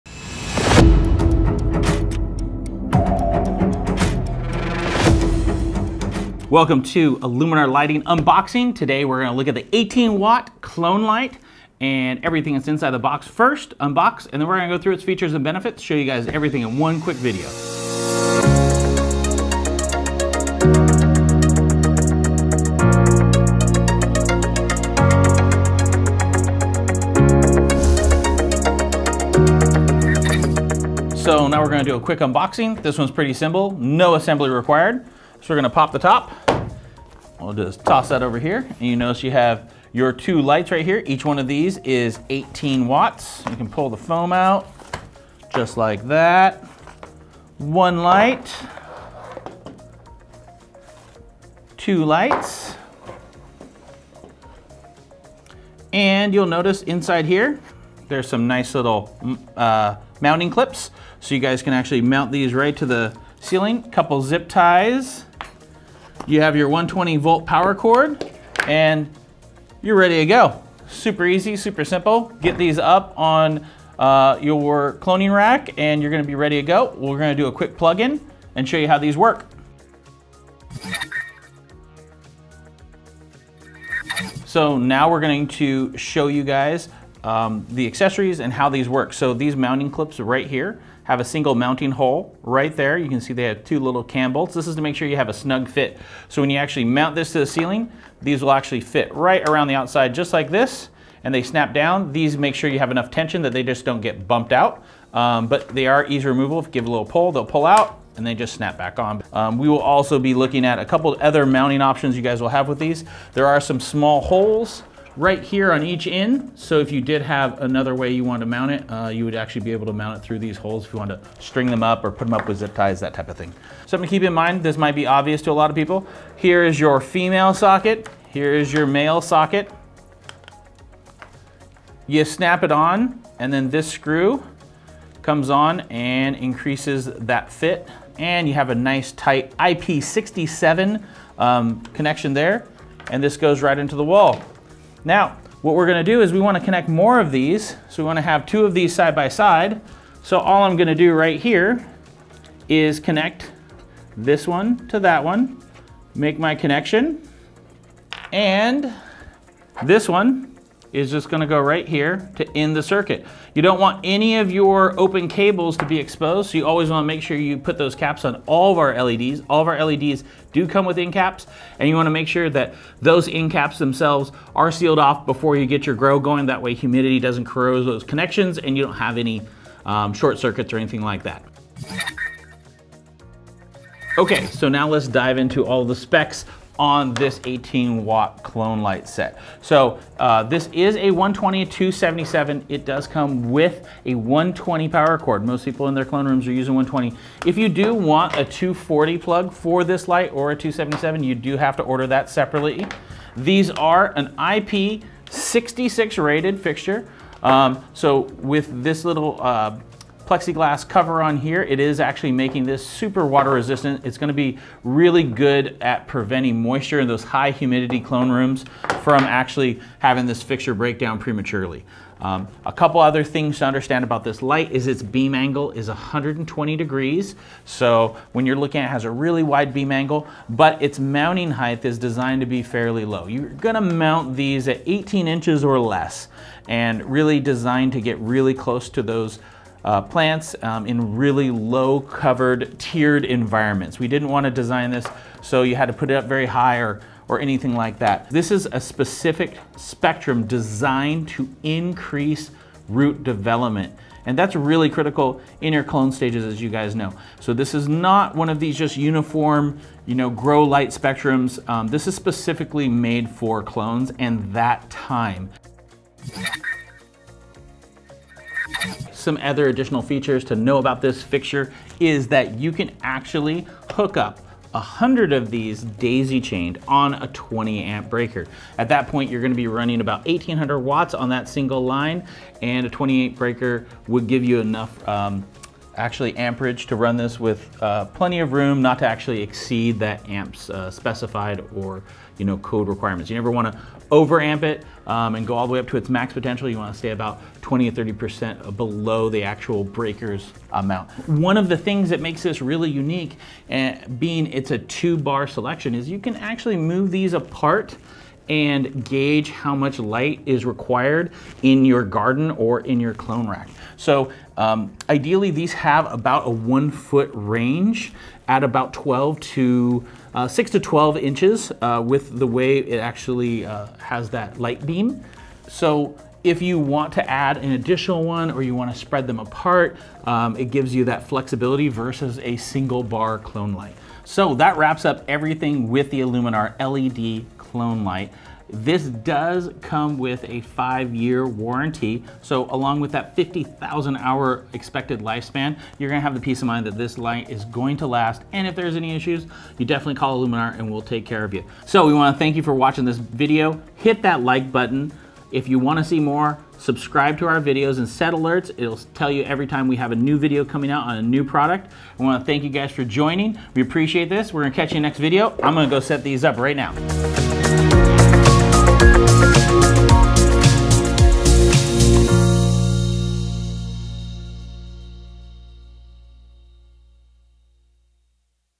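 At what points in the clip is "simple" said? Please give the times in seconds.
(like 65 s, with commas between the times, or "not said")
33 s, 71 s.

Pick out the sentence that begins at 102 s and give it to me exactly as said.
These make sure you have enough tension that they just don't get bumped out.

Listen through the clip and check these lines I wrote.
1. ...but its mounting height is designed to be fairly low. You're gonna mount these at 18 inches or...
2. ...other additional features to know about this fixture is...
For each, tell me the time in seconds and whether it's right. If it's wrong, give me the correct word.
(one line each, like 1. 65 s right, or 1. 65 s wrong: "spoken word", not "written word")
1. 230 s right
2. 269 s right.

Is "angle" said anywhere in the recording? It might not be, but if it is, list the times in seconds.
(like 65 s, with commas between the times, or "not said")
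225 s, 229 s.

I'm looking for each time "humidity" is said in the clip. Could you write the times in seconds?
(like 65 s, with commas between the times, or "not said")
176 s, 217 s.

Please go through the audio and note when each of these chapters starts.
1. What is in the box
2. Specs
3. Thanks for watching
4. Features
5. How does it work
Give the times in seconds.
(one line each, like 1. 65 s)
1. 29 s
2. 182 s
3. 352 s
4. 267 s
5. 82 s.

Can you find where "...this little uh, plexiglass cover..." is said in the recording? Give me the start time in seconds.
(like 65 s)
208 s.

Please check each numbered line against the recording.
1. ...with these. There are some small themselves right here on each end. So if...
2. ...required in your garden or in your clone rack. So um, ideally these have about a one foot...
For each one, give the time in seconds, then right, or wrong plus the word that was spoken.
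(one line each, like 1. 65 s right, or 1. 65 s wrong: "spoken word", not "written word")
1. 112 s wrong: "holes", not "themselves"
2. 310 s right.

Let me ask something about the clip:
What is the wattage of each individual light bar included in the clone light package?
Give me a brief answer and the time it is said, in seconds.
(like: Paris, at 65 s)
18 watts, at 42 s.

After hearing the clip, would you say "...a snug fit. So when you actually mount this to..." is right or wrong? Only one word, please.
right.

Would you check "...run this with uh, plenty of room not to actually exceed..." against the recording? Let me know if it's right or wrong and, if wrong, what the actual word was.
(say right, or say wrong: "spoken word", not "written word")
right.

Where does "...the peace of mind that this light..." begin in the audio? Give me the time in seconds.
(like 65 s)
346 s.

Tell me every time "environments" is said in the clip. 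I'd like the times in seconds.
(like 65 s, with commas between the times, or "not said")
243 s.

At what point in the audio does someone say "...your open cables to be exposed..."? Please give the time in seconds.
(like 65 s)
164 s.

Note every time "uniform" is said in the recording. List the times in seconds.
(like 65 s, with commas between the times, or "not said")
258 s.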